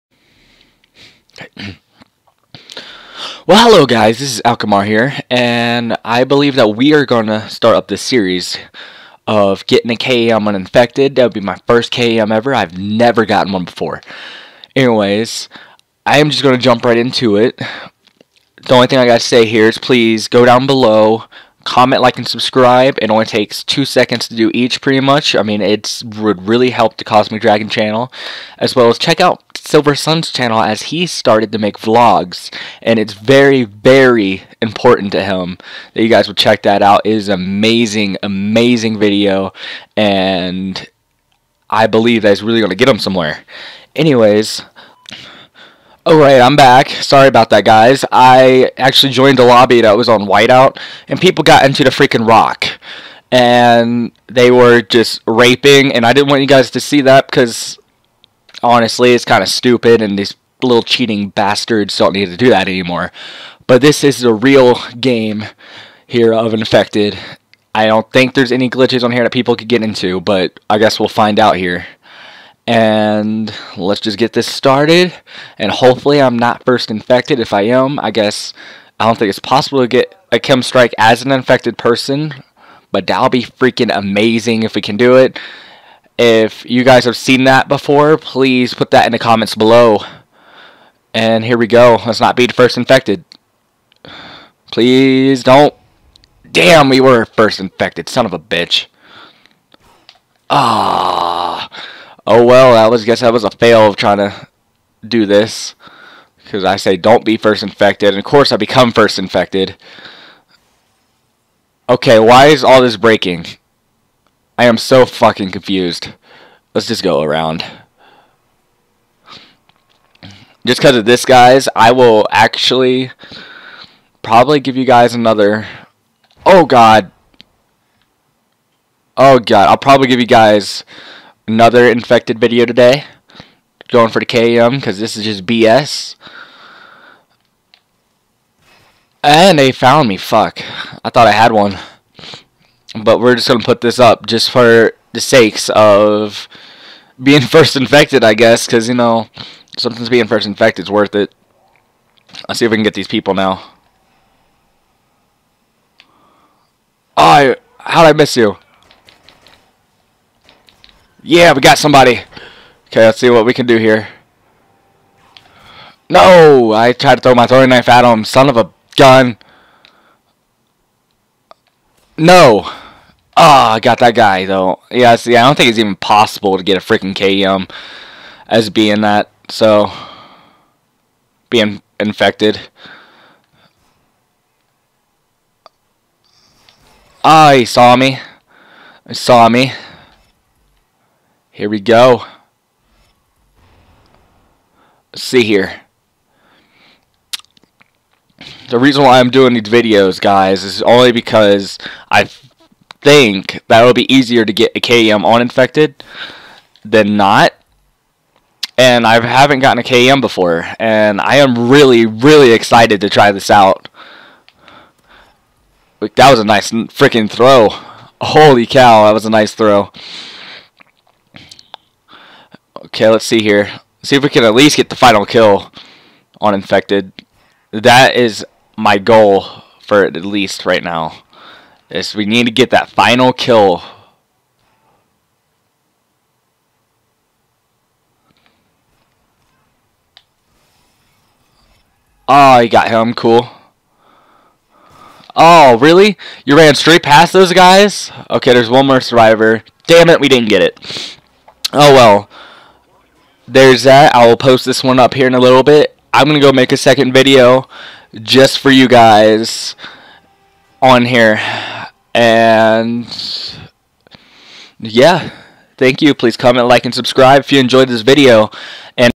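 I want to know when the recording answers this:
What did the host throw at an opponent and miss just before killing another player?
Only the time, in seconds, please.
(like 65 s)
167 s.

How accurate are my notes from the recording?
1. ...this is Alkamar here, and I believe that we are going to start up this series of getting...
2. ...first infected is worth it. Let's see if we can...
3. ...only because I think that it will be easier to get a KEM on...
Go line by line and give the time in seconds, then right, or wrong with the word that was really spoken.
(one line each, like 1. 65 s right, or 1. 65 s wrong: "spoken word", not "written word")
1. 4 s right
2. 150 s right
3. 200 s right.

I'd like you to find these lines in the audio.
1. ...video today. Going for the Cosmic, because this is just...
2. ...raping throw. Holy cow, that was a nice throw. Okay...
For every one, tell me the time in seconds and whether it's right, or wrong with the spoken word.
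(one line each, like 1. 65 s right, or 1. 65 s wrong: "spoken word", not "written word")
1. 132 s wrong: "KEM", not "Cosmic"
2. 216 s wrong: "freaking", not "raping".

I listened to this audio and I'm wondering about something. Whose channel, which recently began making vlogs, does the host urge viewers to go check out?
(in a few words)
Silver Sun.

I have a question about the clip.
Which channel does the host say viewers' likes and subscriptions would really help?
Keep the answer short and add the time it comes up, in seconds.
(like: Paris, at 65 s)
Cosmic Dragon, at 27 s.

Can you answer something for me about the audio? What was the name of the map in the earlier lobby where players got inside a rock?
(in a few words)
Whiteout.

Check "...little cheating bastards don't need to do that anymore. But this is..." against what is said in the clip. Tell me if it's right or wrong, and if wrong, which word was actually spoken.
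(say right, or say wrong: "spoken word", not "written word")
right.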